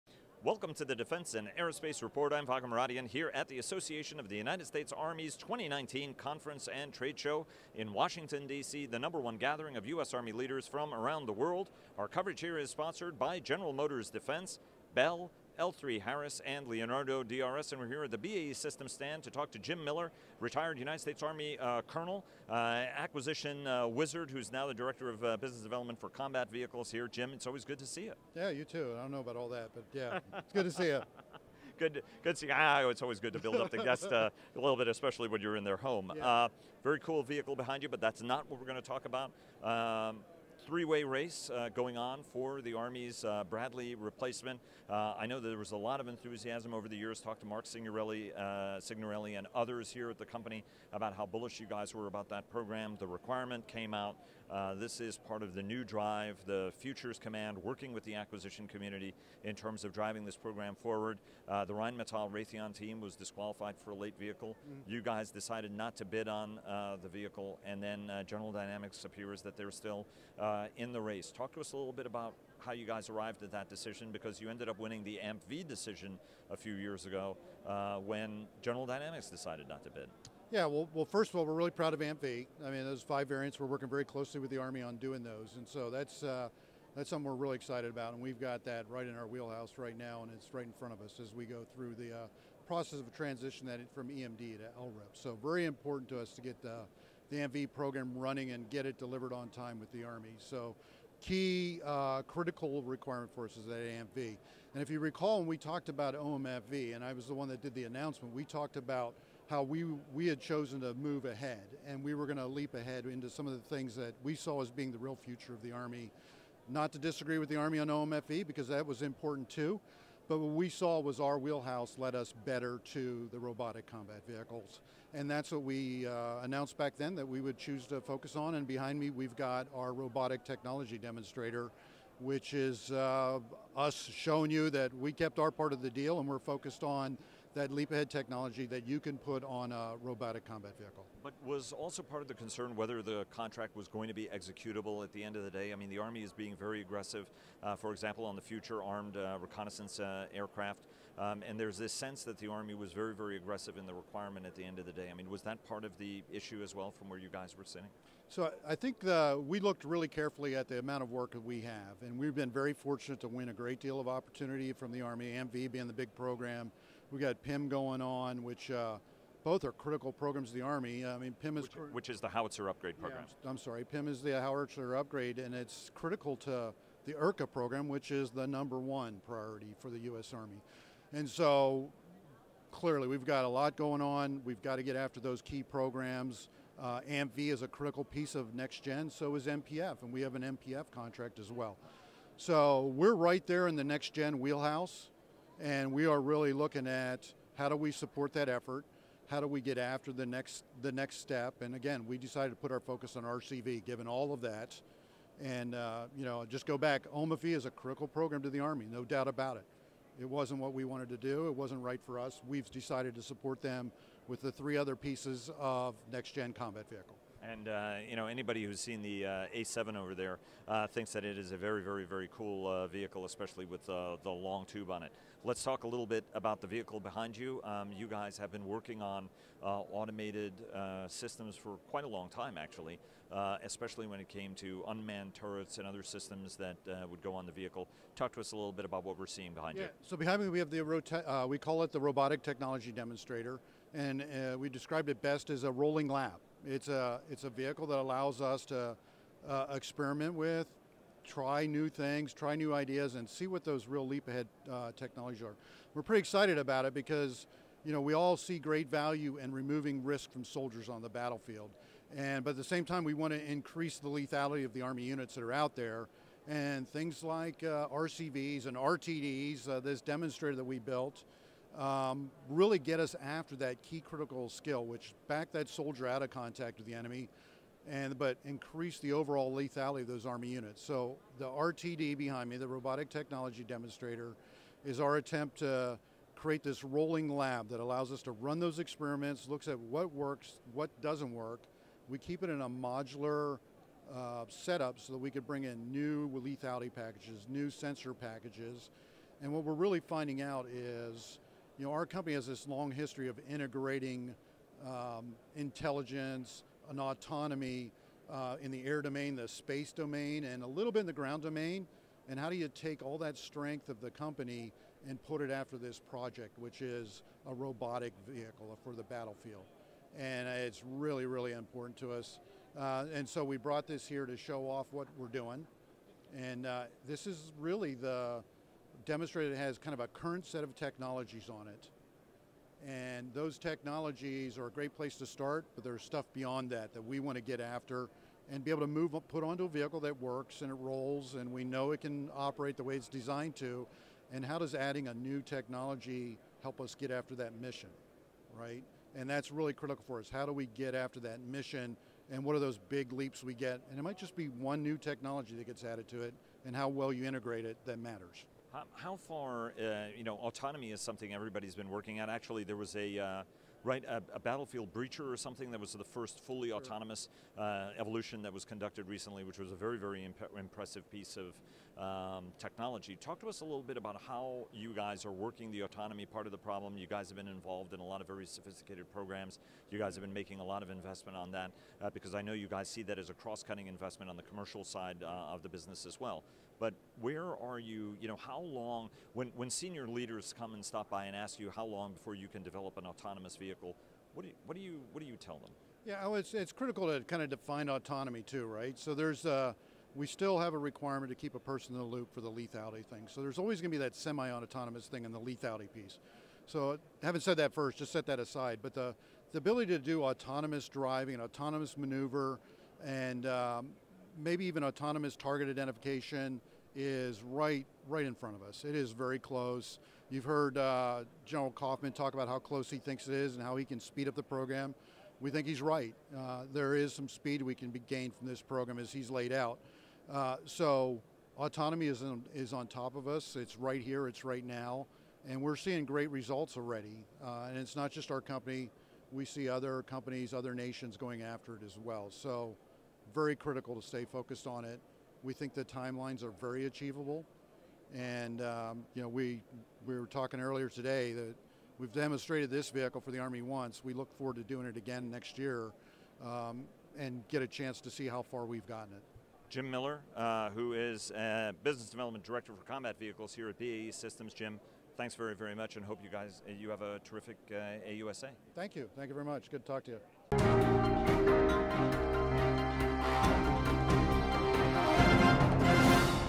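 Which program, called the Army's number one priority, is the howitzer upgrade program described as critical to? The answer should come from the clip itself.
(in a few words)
ERCA.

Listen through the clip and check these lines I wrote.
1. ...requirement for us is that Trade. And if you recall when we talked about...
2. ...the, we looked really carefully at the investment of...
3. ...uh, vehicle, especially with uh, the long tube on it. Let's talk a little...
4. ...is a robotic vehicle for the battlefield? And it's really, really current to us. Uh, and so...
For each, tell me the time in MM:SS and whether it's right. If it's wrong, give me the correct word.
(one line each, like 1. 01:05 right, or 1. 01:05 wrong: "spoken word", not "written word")
1. 01:42 wrong: "AMV", not "Trade"
2. 02:39 wrong: "amount", not "investment"
3. 03:42 right
4. 05:16 wrong: "important", not "current".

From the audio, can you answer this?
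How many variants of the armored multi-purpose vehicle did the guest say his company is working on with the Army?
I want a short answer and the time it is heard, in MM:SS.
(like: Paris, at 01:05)
5, at 01:23.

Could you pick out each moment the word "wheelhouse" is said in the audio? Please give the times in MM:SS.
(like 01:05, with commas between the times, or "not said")
01:29, 02:01, 03:14.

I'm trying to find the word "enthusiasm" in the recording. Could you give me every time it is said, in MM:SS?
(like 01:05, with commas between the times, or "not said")
00:46.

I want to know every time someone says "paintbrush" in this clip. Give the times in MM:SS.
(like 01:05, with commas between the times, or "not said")
not said.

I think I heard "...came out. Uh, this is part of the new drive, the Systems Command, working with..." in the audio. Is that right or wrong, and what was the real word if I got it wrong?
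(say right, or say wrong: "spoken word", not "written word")
wrong: "Futures", not "Systems".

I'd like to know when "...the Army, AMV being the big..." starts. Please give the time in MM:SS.
02:44.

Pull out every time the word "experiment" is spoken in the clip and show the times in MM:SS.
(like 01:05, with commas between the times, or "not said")
04:09, 04:48.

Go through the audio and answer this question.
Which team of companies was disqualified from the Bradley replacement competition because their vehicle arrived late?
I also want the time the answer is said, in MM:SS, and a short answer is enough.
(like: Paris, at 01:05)
Rheinmetall Raytheon, at 01:01.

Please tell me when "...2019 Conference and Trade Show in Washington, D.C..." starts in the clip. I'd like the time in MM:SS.
00:05.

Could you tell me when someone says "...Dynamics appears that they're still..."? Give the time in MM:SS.
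01:08.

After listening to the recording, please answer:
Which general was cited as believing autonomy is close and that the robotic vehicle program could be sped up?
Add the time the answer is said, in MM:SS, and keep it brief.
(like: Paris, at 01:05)
General Coffman, at 07:01.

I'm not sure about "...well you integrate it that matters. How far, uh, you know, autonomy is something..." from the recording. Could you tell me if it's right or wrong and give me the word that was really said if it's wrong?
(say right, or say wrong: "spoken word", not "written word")
right.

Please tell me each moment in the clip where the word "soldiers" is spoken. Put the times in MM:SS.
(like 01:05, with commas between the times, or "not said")
04:20, 04:35.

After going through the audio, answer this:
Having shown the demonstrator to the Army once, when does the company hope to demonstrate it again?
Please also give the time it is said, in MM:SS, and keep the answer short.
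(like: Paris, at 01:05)
next year, at 07:35.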